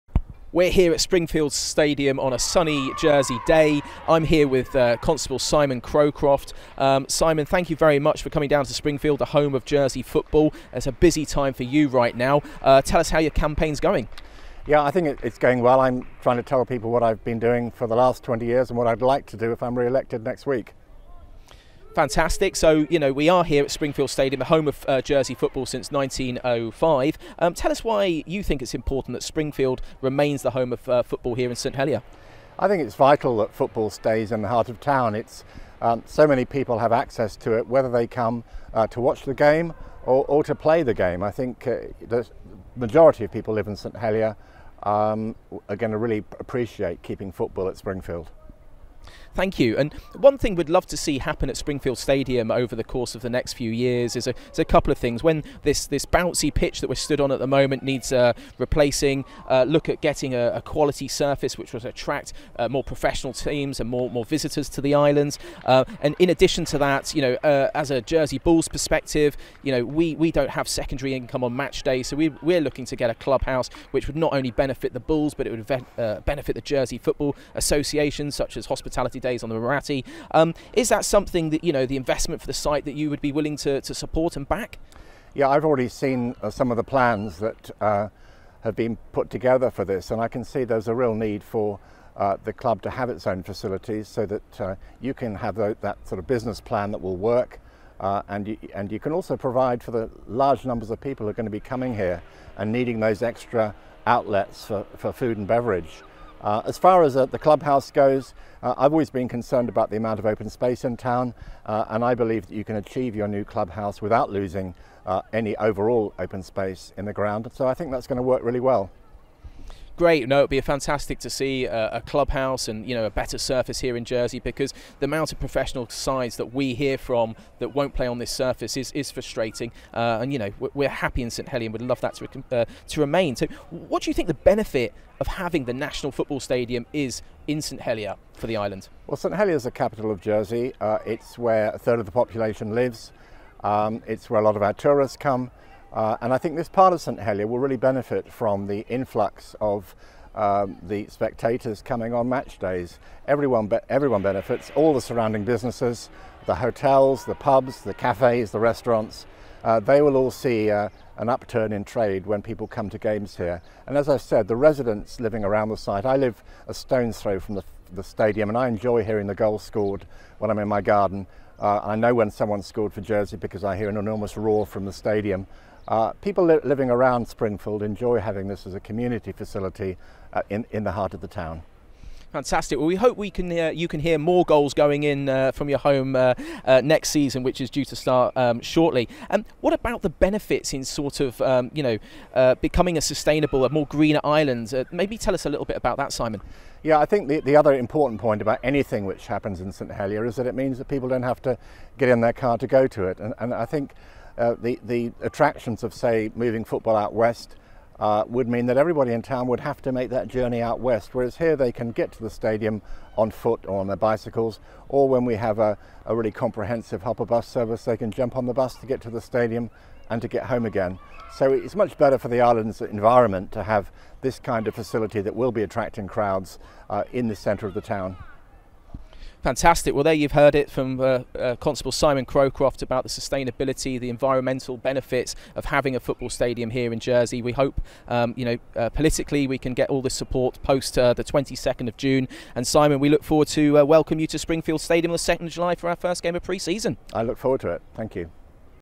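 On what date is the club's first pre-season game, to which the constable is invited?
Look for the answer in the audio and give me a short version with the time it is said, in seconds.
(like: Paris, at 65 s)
2nd of July, at 245 s.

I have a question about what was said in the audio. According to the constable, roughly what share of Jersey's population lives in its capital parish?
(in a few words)
a third.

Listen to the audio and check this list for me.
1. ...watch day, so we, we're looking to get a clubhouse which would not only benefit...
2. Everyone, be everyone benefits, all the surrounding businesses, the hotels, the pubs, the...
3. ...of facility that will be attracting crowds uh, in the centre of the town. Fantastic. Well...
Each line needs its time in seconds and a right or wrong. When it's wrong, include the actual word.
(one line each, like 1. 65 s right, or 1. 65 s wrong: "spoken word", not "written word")
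1. 71 s wrong: "match", not "watch"
2. 153 s right
3. 224 s right.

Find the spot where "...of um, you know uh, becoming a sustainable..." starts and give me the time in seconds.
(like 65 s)
191 s.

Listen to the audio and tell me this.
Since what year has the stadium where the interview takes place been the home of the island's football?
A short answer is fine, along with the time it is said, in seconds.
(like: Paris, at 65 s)
1905, at 25 s.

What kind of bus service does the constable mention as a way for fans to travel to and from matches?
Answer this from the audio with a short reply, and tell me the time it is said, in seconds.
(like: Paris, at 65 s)
hopper bus service, at 217 s.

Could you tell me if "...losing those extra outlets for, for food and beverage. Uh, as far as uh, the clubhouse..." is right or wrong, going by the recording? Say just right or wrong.
wrong.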